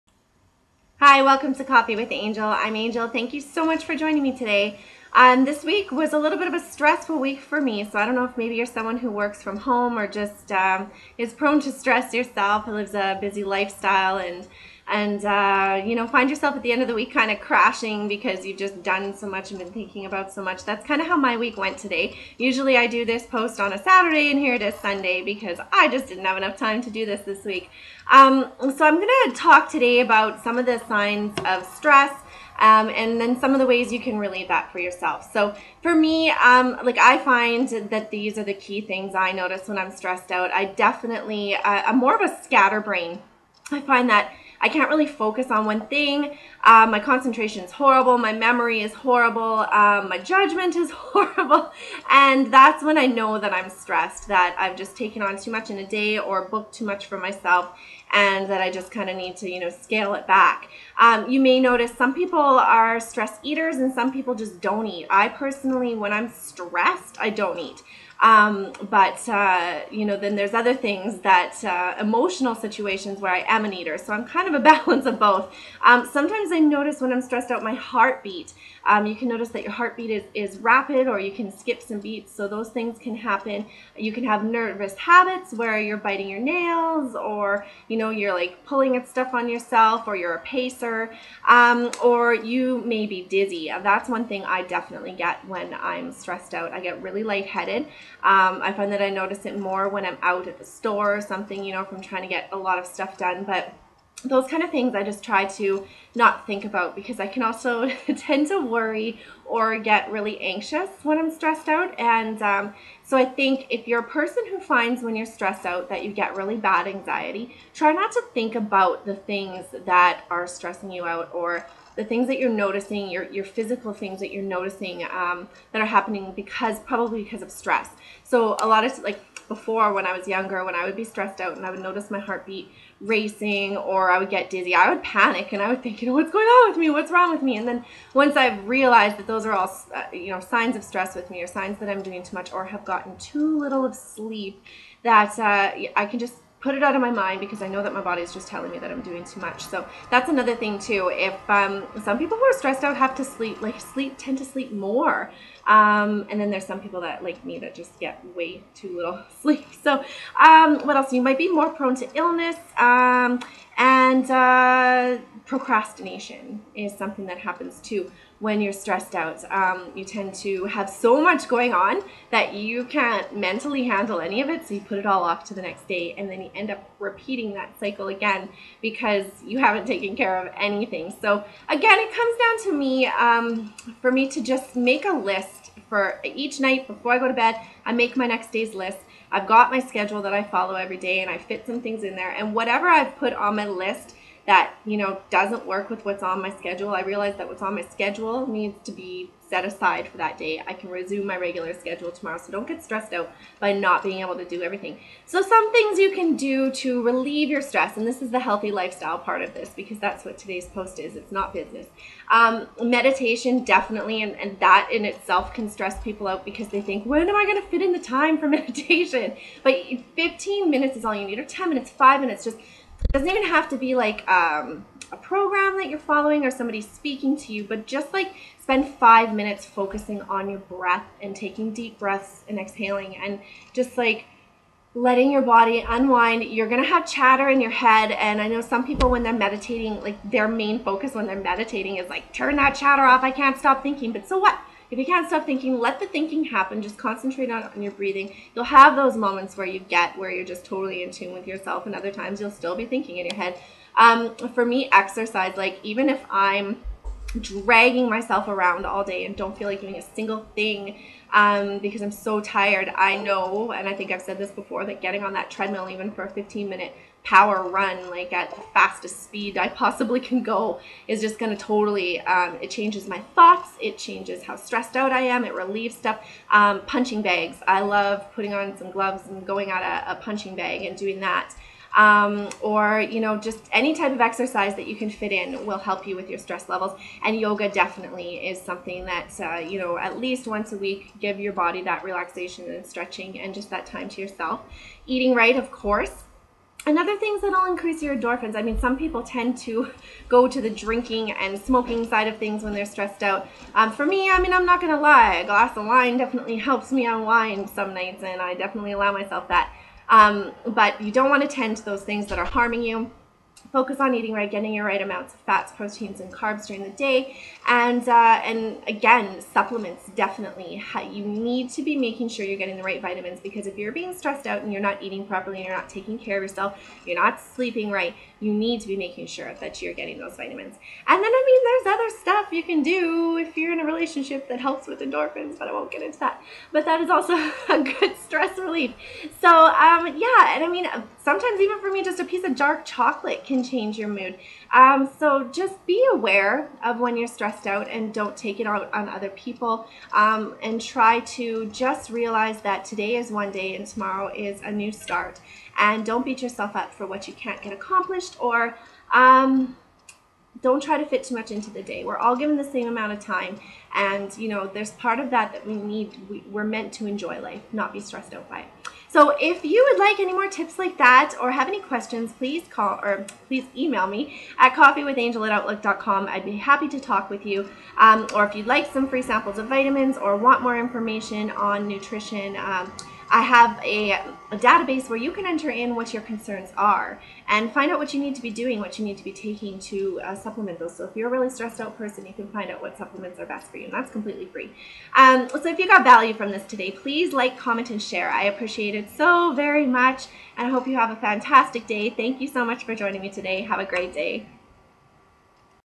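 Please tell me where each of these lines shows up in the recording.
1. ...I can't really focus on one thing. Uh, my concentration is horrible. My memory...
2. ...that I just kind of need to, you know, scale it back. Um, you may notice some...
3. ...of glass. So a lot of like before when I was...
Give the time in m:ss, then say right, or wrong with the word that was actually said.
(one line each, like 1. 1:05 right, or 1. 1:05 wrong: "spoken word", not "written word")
1. 0:44 right
2. 0:58 right
3. 2:07 wrong: "stress", not "glass".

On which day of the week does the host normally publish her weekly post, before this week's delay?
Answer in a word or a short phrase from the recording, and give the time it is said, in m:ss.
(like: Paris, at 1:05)
Saturday, at 0:23.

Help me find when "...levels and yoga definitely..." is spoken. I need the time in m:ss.
4:46.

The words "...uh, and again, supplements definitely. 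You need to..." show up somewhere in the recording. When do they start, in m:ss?
5:18.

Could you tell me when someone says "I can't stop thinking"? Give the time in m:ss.
4:03.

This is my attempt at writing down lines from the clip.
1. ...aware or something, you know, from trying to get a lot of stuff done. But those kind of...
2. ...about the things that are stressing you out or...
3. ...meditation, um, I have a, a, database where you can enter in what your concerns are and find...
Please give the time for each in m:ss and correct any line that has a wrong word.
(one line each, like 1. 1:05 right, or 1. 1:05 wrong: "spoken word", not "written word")
1. 1:40 wrong: "store", not "aware"
2. 1:58 right
3. 6:21 wrong: "nutrition", not "meditation".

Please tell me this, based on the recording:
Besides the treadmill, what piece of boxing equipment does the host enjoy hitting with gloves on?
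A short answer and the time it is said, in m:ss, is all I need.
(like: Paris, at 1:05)
punching bag, at 4:36.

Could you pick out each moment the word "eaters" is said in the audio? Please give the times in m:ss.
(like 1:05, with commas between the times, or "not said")
1:03, 1:13.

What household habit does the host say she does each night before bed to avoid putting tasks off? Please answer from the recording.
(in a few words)
make my next day's list.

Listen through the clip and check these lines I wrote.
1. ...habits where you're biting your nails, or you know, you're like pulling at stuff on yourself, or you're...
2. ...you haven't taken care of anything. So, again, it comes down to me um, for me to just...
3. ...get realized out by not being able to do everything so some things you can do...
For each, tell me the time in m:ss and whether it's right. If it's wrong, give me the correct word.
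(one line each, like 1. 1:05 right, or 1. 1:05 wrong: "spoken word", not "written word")
1. 1:24 right
2. 2:59 right
3. 3:22 wrong: "stressed", not "realized".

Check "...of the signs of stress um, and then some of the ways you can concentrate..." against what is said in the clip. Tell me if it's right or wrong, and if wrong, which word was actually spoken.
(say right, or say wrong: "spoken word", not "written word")
wrong: "relate", not "concentrate".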